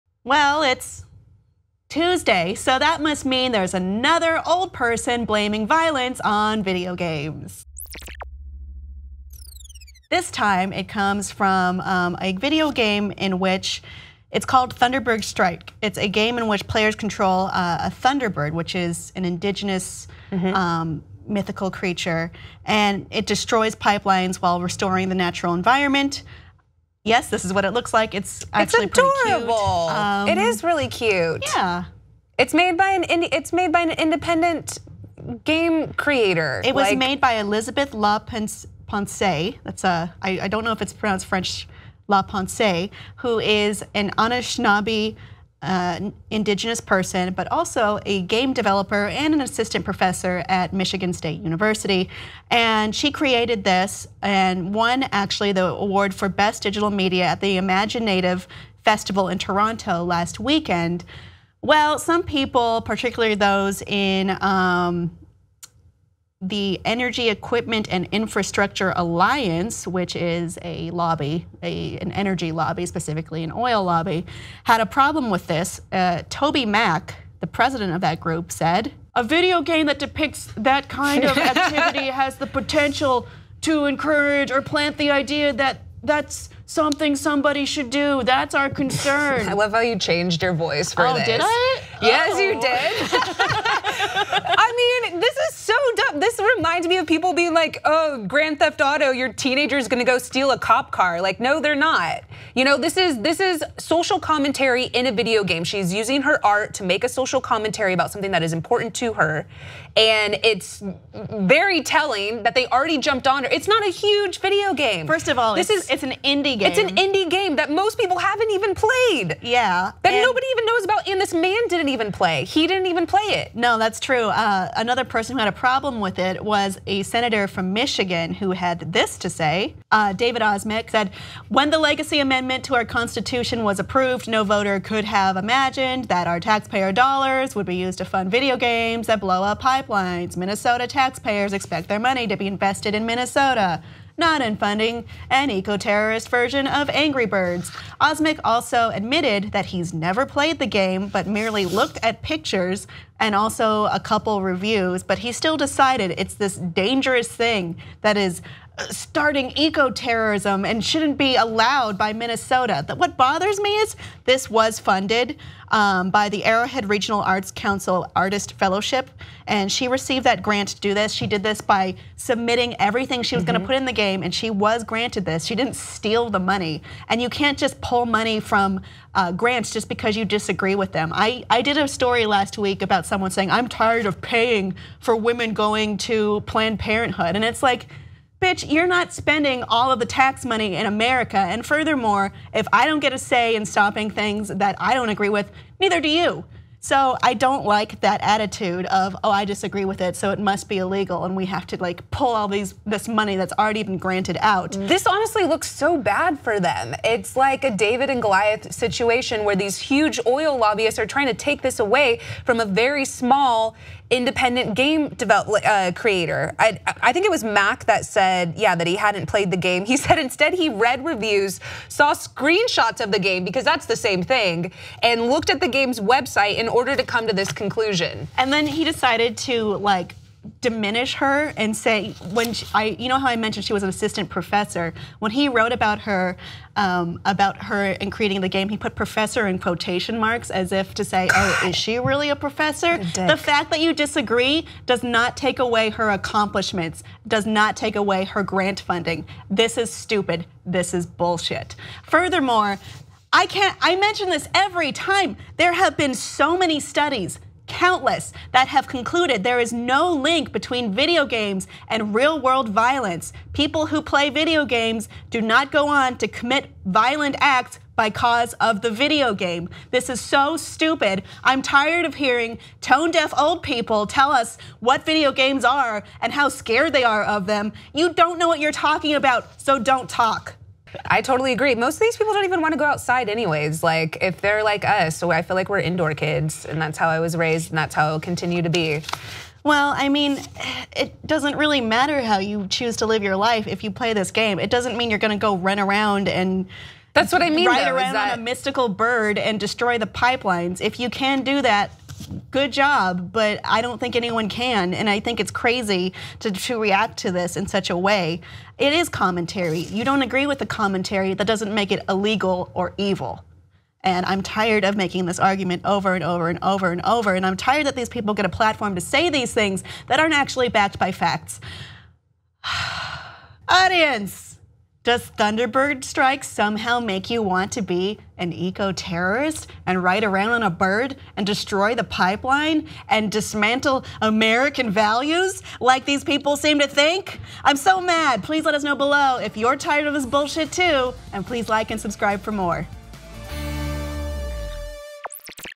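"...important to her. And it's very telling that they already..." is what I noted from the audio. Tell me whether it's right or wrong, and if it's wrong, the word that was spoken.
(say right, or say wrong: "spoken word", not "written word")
right.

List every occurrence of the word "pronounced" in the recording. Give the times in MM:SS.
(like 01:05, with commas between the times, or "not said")
00:40.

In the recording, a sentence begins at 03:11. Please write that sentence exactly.
And furthermore, if I don't get a say in stopping things that I don't agree with, neither do you.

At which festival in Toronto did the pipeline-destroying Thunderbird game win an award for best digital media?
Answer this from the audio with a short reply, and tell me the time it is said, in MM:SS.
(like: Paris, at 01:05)
imagineNATIVE Festival, at 00:57.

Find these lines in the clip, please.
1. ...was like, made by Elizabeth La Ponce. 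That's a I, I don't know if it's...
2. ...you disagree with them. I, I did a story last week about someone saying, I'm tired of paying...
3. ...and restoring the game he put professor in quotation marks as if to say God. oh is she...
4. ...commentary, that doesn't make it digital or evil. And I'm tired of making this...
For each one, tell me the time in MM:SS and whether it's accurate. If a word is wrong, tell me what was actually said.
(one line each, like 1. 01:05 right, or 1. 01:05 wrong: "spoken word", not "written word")
1. 00:36 right
2. 03:00 right
3. 03:58 wrong: "creating", not "restoring"
4. 05:10 wrong: "illegal", not "digital".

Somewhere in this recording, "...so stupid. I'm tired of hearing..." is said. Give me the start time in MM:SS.
04:30.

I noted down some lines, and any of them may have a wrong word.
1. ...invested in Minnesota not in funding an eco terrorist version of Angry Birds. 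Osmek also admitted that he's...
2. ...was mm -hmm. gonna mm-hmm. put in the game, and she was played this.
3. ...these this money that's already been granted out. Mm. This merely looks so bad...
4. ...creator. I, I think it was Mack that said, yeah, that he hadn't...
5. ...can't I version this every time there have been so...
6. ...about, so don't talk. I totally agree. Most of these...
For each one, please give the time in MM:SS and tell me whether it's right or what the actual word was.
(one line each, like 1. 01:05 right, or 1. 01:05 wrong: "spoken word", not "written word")
1. 02:22 right
2. 02:53 wrong: "granted", not "played"
3. 03:22 wrong: "honestly", not "merely"
4. 03:35 right
5. 04:13 wrong: "mention", not "version"
6. 04:39 right.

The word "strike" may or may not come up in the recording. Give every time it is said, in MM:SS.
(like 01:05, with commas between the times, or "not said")
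00:15, 05:26.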